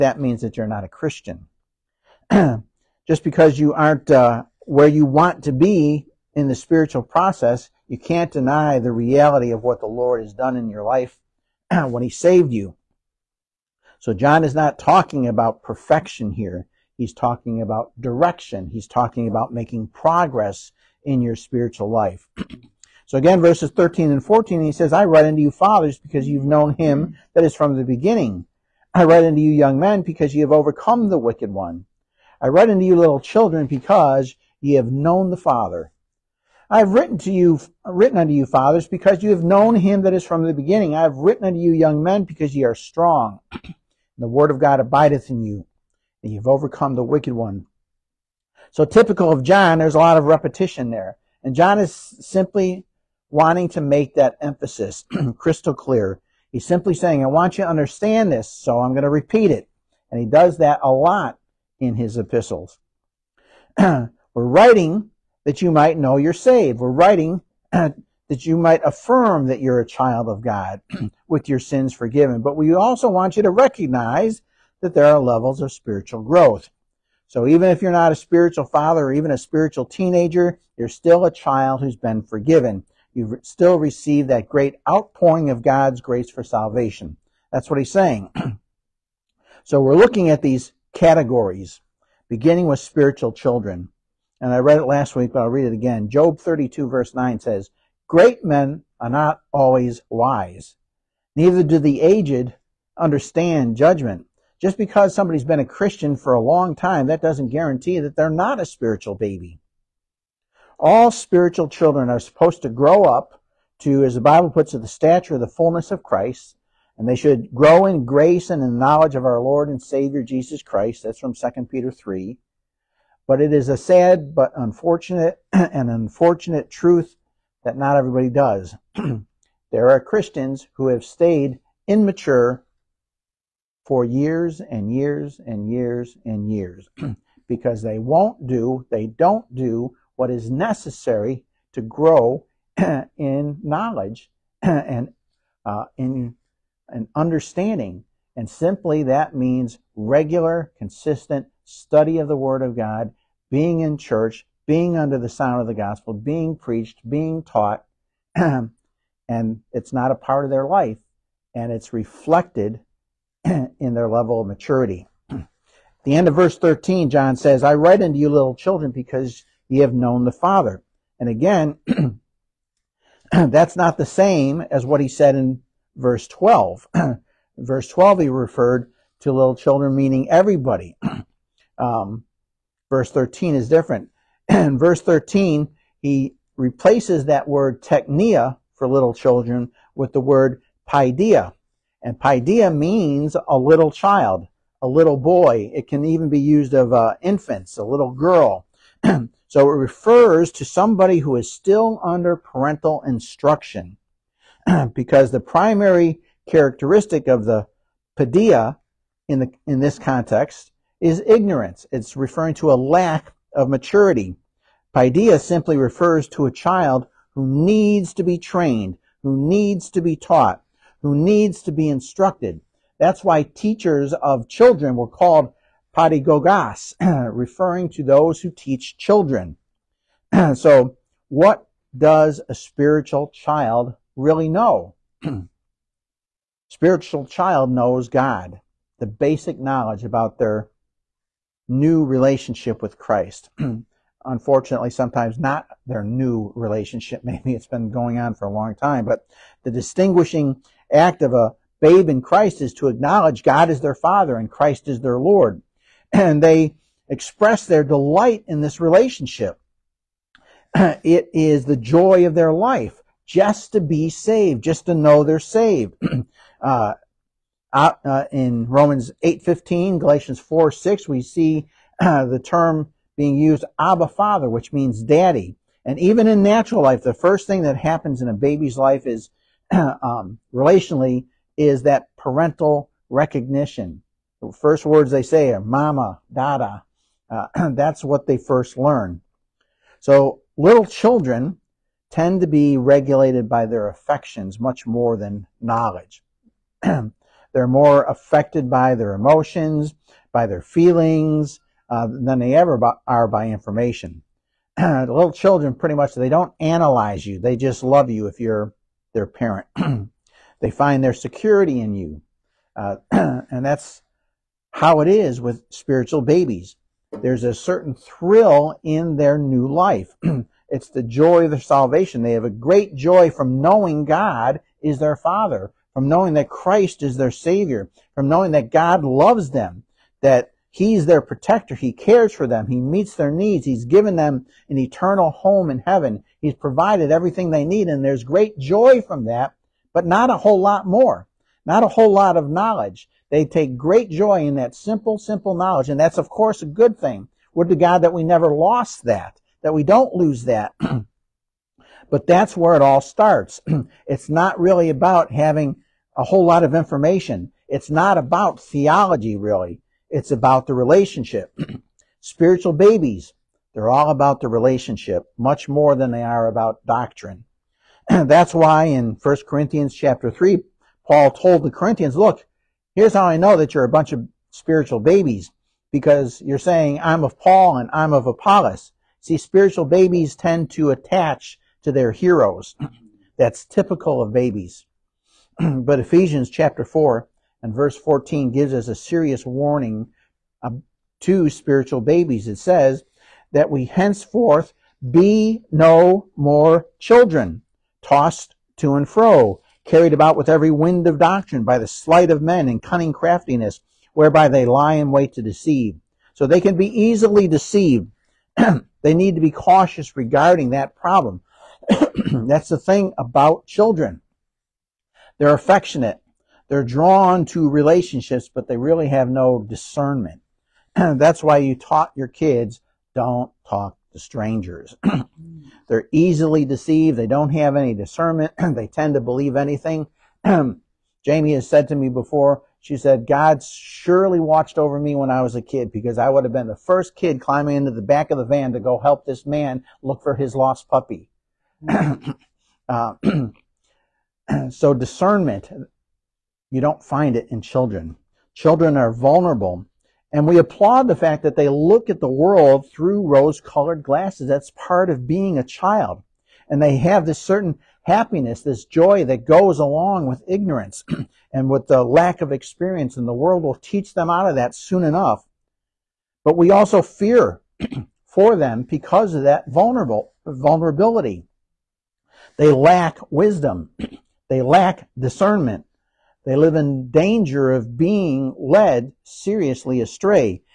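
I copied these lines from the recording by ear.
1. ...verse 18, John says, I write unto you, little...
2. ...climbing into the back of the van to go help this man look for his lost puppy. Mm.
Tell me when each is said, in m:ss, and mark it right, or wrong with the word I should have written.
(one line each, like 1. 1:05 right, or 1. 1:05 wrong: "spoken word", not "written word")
1. 2:46 wrong: "13", not "18"
2. 7:17 right.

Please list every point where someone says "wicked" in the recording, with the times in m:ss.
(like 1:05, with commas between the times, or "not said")
0:31, 0:47.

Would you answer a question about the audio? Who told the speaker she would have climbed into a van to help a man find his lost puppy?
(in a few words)
Jamie.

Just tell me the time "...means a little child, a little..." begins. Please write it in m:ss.
3:12.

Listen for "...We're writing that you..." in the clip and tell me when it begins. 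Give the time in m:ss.
1:03.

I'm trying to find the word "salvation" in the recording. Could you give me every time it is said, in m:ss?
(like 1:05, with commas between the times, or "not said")
1:26, 5:21.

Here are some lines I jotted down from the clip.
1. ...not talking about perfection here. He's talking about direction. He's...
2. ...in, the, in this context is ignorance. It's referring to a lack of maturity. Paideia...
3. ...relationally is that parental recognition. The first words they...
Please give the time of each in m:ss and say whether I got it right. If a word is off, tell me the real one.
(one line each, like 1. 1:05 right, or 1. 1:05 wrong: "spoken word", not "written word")
1. 0:14 right
2. 3:29 right
3. 4:40 right.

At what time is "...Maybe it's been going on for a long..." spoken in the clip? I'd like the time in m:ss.
4:07.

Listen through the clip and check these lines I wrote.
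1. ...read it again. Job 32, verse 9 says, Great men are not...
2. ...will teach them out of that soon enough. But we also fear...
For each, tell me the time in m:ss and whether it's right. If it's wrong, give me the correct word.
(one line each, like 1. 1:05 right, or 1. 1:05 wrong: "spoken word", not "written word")
1. 1:35 right
2. 7:43 right.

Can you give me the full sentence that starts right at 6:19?
See, spiritual babies tend to attach to their heroes.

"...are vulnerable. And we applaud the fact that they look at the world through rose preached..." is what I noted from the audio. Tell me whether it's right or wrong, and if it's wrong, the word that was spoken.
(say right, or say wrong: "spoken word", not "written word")
wrong: "colored", not "preached".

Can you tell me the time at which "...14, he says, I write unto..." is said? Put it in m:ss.
0:24.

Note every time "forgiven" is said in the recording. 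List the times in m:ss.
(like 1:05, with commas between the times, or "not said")
1:11, 1:22.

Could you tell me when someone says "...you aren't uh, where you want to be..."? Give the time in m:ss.
0:03.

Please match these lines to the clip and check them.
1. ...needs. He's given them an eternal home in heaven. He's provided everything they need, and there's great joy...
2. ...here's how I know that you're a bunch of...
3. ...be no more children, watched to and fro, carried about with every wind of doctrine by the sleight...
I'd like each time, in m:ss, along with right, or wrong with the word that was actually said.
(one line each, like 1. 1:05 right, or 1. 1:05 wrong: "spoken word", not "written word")
1. 5:33 right
2. 6:12 right
3. 6:35 wrong: "tossed", not "watched".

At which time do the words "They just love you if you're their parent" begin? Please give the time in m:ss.
5:07.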